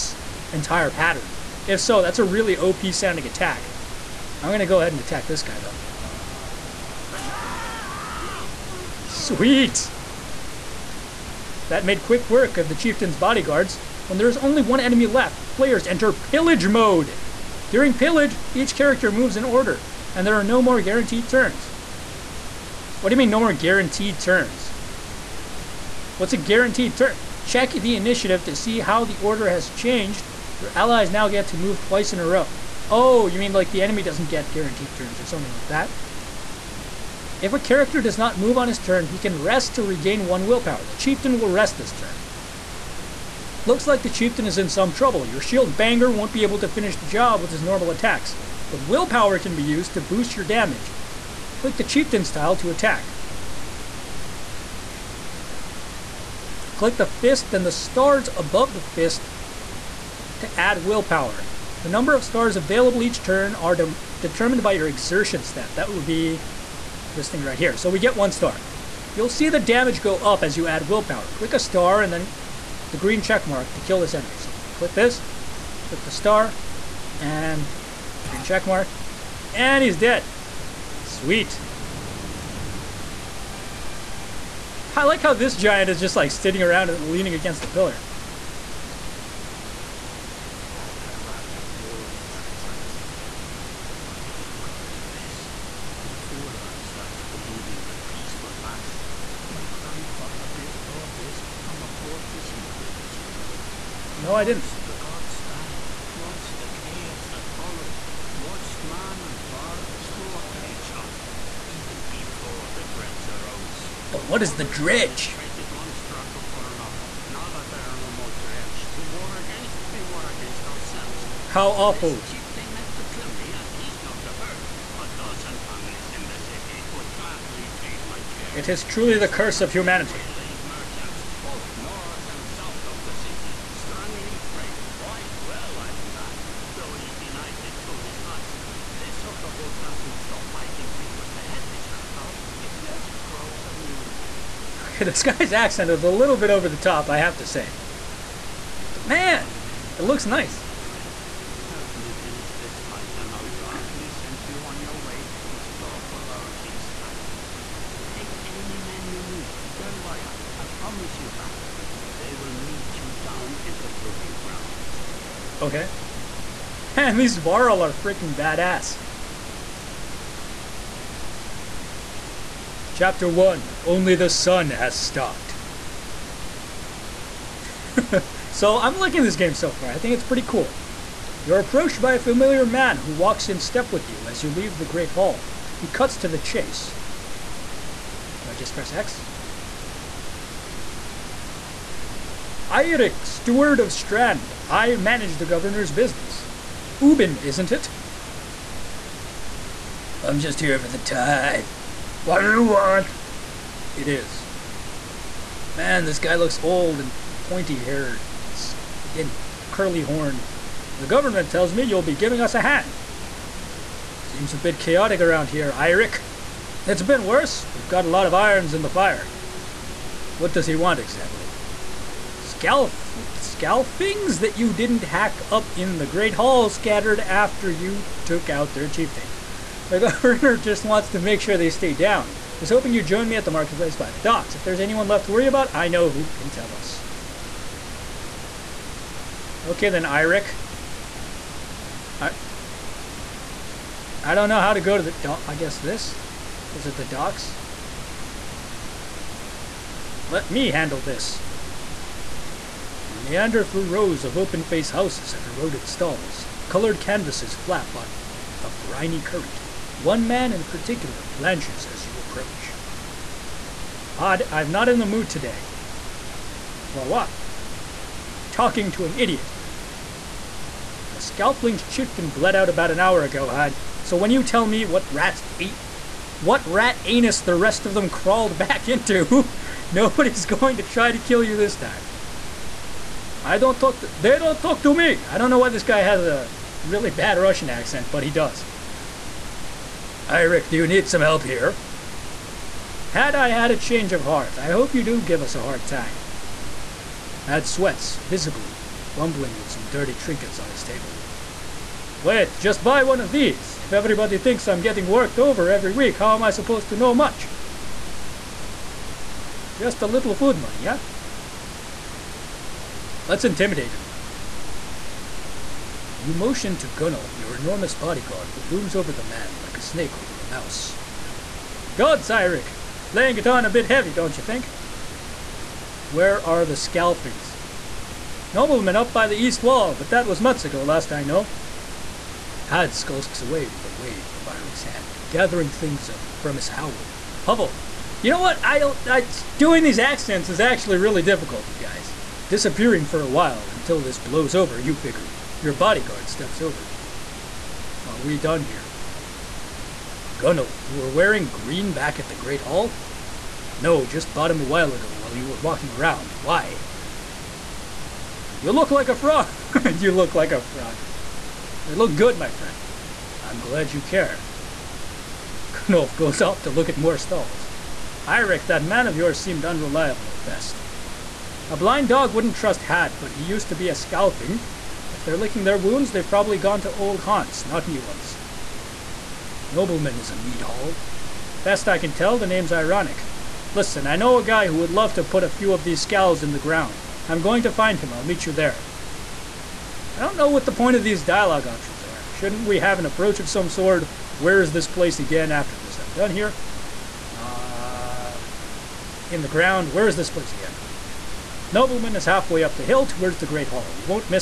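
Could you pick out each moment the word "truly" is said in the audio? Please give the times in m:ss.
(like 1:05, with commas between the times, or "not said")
2:08.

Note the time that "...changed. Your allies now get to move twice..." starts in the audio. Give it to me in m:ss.
0:29.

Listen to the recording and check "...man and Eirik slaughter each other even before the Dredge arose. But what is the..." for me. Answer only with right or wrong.
wrong.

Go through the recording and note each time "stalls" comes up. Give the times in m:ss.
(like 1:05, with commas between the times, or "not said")
4:15, 6:07.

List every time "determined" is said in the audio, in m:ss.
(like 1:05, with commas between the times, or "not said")
1:04.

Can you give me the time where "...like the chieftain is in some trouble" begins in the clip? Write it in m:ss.
0:43.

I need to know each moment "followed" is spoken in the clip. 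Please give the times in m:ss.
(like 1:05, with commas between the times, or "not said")
1:47.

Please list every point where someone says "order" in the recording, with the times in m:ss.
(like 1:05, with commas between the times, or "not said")
0:19, 0:29.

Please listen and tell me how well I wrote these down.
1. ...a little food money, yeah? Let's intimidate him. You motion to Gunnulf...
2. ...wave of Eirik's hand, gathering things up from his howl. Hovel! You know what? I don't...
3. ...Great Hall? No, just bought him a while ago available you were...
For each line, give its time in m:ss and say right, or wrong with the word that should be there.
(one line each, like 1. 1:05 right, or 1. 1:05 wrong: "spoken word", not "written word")
1. 5:10 right
2. 5:33 right
3. 5:52 wrong: "while", not "available".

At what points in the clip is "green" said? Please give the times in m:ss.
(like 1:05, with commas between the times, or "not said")
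1:12, 1:18, 5:51.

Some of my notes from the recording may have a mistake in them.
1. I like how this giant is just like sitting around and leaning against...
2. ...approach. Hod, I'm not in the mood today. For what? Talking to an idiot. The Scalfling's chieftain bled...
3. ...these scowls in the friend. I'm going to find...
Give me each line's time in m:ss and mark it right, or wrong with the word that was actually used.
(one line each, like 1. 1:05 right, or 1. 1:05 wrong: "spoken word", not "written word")
1. 1:24 right
2. 4:22 right
3. 6:25 wrong: "ground", not "friend".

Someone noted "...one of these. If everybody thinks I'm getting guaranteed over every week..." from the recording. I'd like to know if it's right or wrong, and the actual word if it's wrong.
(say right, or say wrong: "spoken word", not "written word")
wrong: "worked", not "guaranteed".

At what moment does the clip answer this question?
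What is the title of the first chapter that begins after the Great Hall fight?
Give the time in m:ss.
2:53.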